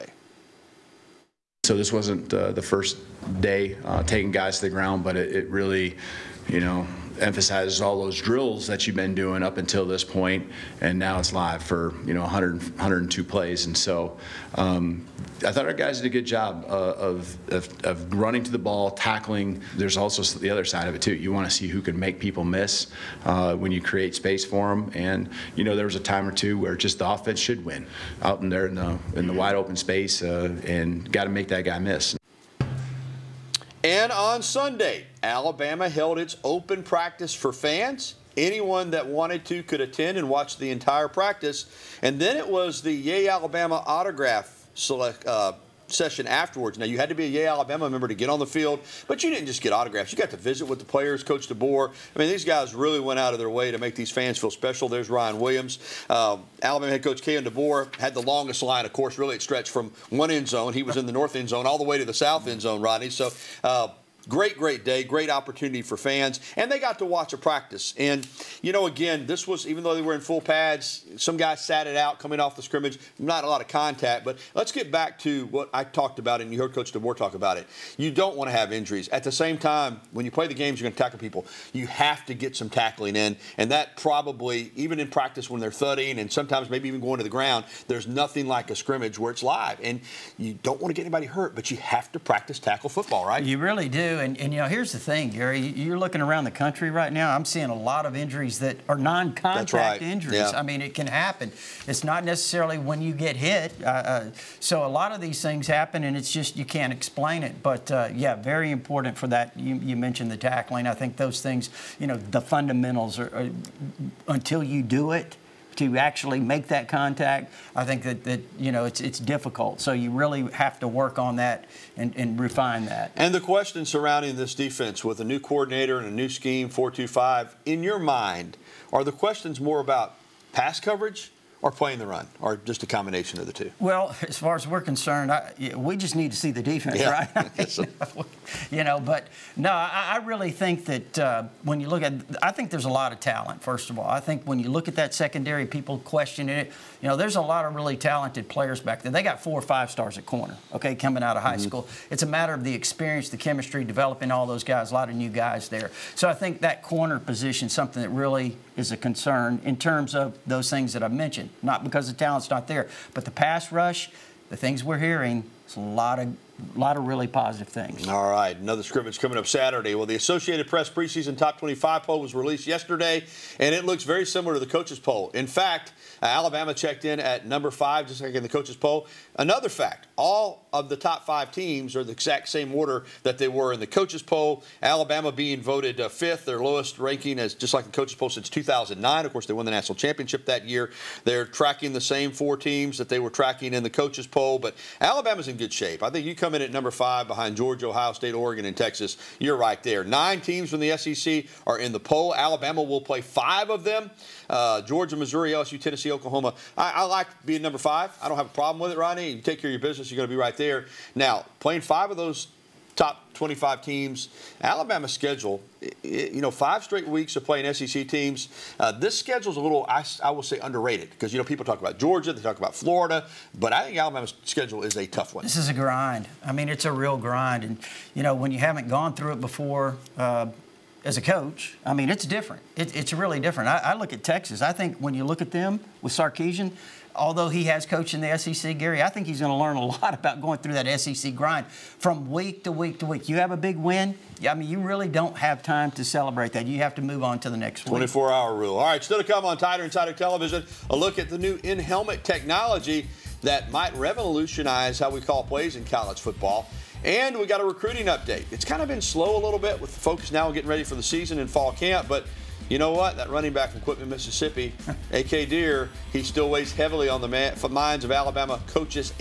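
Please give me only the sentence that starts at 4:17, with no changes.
And we got a recruiting update.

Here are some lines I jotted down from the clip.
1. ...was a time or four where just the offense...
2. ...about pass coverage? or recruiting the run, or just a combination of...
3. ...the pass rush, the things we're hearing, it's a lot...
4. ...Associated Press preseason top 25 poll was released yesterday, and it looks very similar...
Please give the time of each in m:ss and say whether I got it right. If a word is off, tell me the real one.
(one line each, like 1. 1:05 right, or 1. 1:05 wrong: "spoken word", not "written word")
1. 0:25 wrong: "two", not "four"
2. 2:09 wrong: "playing", not "recruiting"
3. 2:43 right
4. 2:50 right.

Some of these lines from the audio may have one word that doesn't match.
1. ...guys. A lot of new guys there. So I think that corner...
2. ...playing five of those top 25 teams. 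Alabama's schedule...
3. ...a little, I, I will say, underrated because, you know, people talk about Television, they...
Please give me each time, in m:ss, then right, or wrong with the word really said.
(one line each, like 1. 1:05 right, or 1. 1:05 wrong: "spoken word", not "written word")
1. 2:34 right
2. 3:31 right
3. 3:39 wrong: "Georgia", not "Television".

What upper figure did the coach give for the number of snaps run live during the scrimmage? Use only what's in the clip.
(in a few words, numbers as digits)
102.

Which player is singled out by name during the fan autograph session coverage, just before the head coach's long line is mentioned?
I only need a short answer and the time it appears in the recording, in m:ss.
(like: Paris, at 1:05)
Ryan Williams, at 0:55.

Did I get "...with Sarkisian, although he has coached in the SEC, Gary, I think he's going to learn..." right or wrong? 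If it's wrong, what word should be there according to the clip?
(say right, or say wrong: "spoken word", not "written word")
right.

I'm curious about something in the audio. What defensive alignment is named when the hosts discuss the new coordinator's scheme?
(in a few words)
4-2-5.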